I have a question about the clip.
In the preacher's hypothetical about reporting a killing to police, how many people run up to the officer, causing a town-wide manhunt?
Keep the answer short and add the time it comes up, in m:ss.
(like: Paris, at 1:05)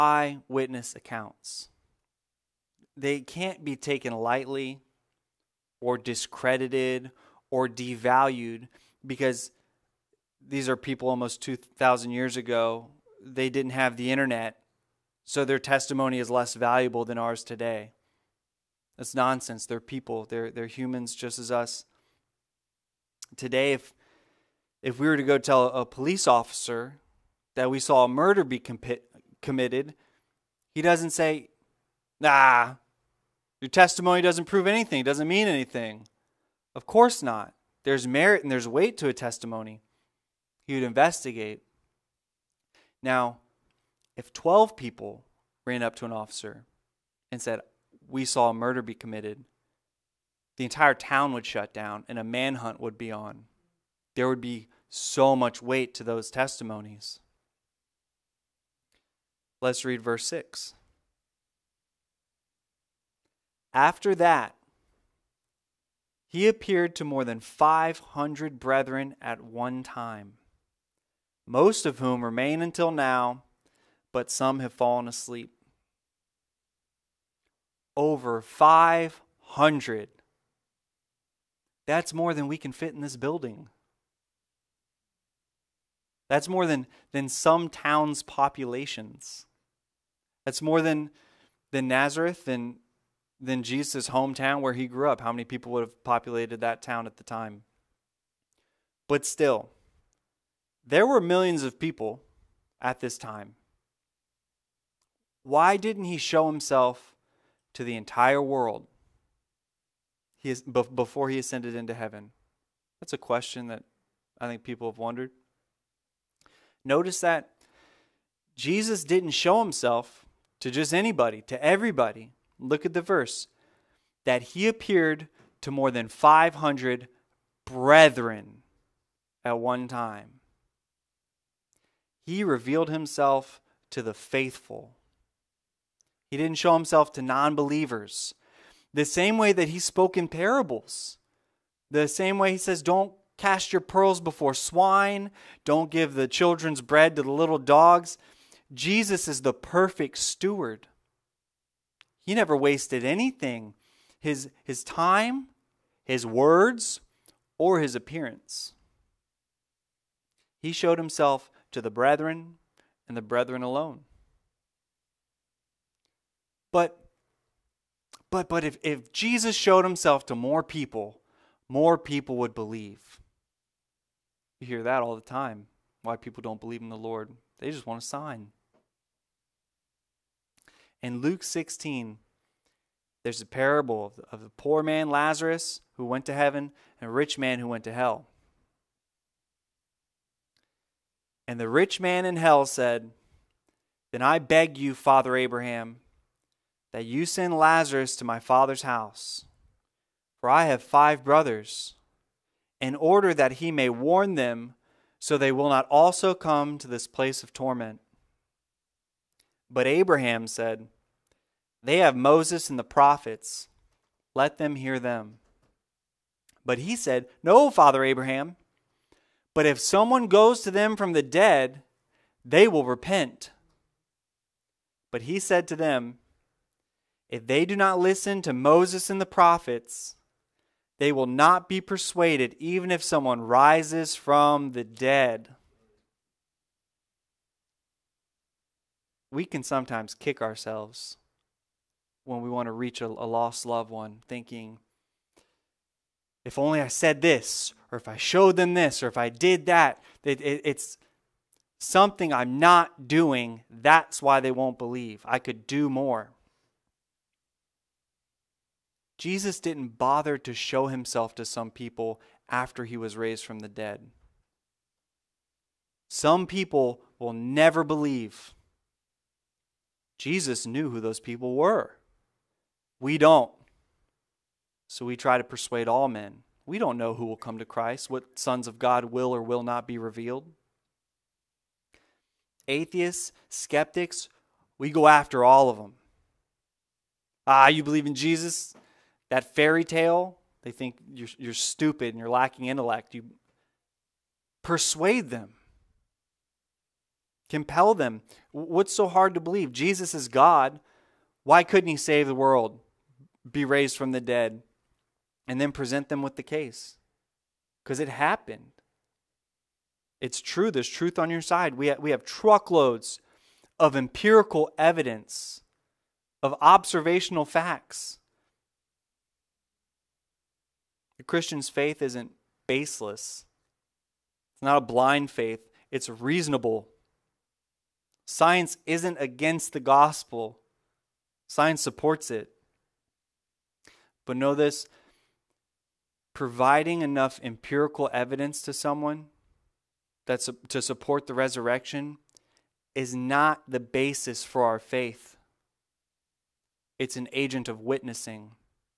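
12, at 0:44.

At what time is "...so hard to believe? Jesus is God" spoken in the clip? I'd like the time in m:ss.
4:58.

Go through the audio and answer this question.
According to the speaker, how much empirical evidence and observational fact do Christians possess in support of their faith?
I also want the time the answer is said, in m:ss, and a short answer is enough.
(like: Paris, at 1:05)
truckloads, at 5:12.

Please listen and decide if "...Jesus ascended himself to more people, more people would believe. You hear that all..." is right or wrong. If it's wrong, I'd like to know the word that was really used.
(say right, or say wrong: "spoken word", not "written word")
wrong: "showed", not "ascended".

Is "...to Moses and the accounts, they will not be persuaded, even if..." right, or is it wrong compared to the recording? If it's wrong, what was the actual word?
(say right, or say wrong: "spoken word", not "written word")
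wrong: "prophets", not "accounts".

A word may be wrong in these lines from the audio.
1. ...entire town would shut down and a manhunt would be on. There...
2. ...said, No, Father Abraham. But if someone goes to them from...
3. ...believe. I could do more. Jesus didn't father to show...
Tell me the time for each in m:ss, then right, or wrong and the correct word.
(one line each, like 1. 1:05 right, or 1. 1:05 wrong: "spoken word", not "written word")
1. 0:50 right
2. 3:36 right
3. 4:14 wrong: "bother", not "father".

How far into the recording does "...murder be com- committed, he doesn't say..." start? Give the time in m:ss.
0:28.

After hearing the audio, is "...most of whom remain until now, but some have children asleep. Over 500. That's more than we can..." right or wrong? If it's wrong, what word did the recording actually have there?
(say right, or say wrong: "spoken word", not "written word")
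wrong: "fallen", not "children".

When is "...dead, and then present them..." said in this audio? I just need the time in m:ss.
5:04.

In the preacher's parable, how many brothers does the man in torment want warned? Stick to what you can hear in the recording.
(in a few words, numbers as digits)
5.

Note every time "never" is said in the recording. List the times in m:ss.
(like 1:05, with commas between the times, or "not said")
2:32, 4:27.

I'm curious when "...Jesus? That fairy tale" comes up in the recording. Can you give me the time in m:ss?
4:48.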